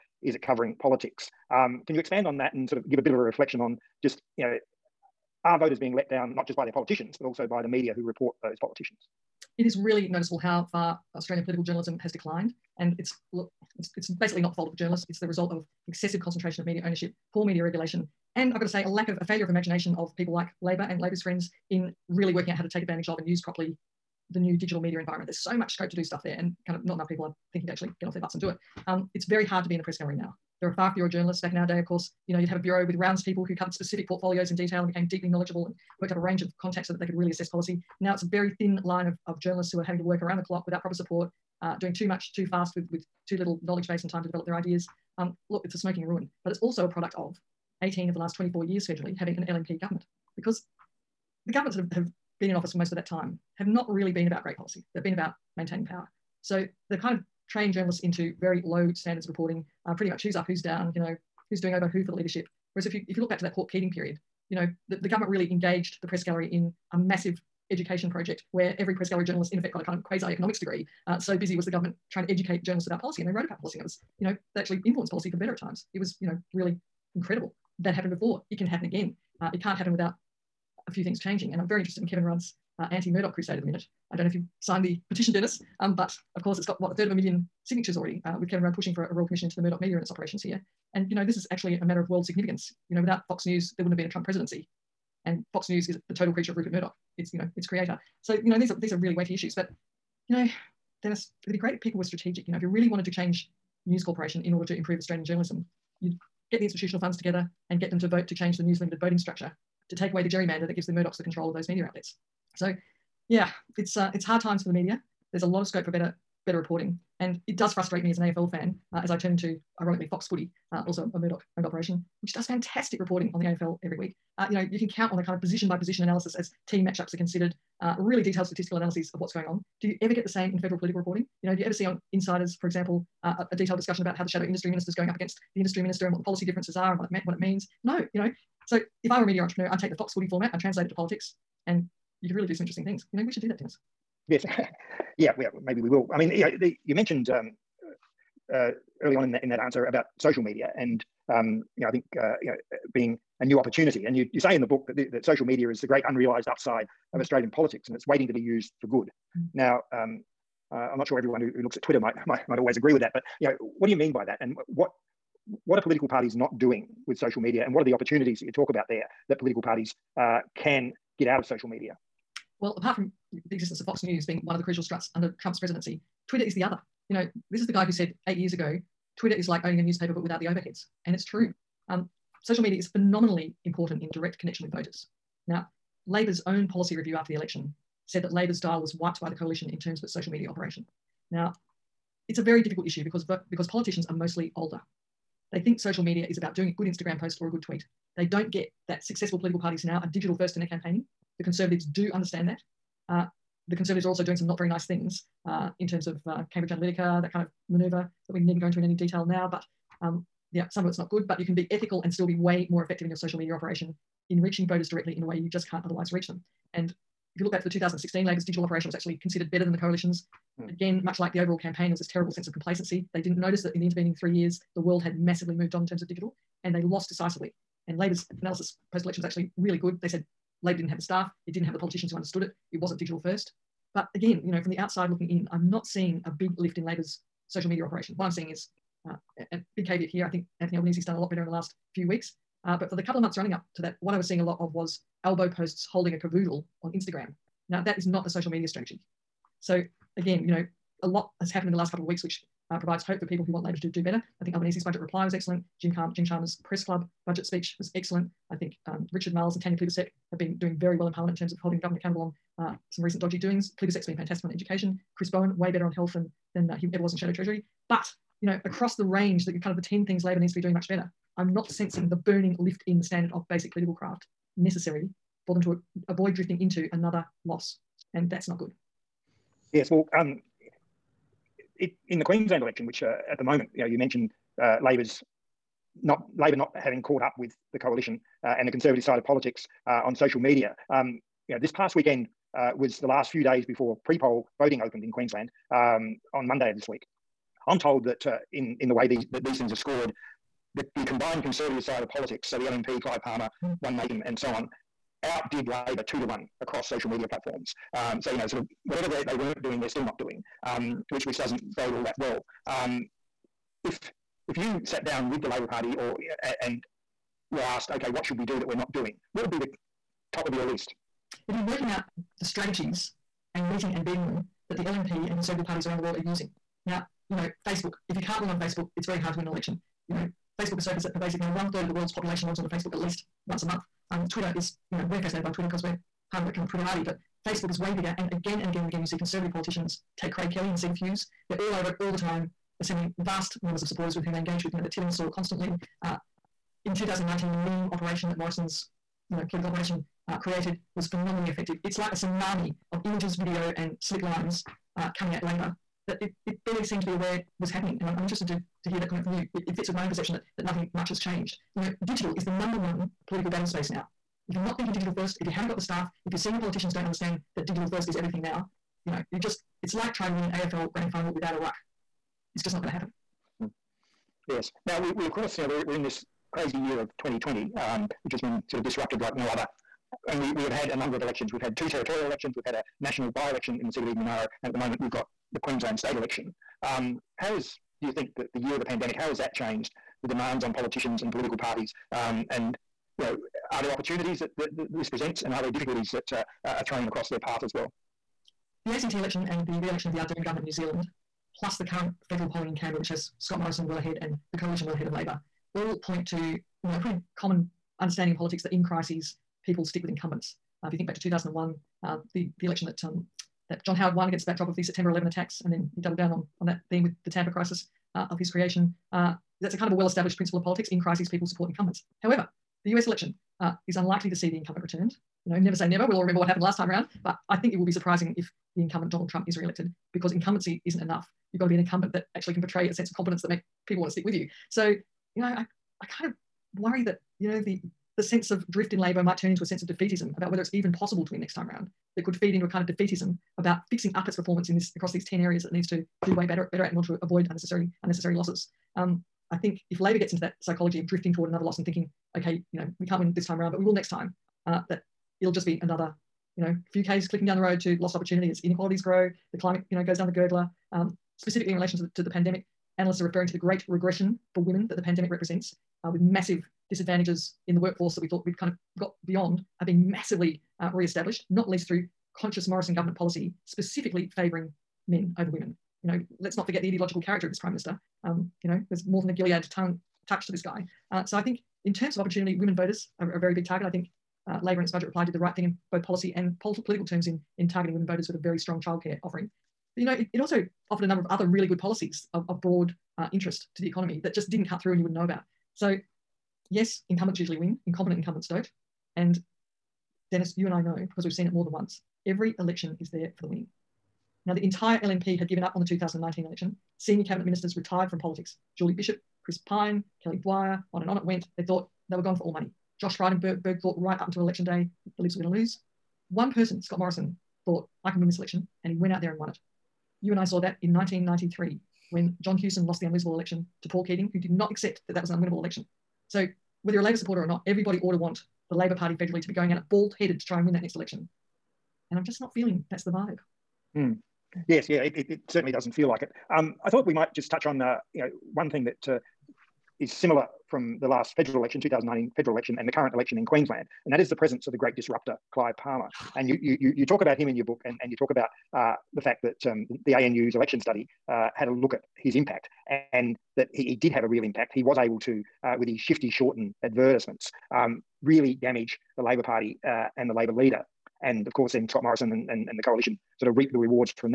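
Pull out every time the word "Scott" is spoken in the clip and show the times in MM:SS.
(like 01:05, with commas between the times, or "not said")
06:43, 08:36, 09:21.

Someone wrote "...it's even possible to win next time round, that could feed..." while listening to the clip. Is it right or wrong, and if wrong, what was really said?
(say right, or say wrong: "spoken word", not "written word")
right.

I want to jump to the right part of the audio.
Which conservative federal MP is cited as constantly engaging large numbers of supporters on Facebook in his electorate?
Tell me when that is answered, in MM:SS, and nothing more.
05:40.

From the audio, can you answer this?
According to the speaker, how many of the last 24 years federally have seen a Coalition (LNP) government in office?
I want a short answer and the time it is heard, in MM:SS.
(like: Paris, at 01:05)
18, at 00:47.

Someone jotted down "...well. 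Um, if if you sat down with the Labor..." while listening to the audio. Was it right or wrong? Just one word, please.
right.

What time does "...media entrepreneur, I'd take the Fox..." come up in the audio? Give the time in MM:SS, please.
02:19.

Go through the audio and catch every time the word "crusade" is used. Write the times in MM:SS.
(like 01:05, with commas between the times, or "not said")
01:23.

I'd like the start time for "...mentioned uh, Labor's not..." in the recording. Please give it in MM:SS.
04:43.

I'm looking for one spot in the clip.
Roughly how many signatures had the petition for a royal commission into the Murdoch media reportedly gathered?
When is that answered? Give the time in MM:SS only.
01:26.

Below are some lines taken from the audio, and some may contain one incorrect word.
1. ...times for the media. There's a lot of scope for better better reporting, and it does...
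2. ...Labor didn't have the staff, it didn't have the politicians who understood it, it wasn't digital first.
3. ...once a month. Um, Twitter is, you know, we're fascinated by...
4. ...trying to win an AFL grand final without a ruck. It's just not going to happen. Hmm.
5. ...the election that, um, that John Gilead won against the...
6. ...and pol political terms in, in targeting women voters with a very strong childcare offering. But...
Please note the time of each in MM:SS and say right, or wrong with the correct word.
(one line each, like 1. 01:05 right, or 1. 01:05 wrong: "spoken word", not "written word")
1. 01:54 right
2. 03:50 right
3. 05:33 right
4. 06:10 right
5. 06:52 wrong: "Howard", not "Gilead"
6. 08:06 right.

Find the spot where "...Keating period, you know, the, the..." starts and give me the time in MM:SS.
01:03.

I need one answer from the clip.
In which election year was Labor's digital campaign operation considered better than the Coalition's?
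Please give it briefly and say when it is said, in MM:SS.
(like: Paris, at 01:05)
2016, at 03:37.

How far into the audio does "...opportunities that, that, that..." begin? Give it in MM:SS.
06:33.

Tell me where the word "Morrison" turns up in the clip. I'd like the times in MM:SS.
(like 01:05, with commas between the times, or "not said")
05:48, 06:43, 07:52, 08:36, 09:22.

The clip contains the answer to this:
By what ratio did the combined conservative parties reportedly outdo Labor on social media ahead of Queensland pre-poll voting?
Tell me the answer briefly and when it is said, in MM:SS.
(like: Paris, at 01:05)
two to one, at 05:06.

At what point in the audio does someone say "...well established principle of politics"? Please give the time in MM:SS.
06:59.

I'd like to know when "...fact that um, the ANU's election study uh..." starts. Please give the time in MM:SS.
09:09.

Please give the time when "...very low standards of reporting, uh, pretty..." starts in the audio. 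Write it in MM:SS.
00:58.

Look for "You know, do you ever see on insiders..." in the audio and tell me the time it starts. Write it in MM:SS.
02:11.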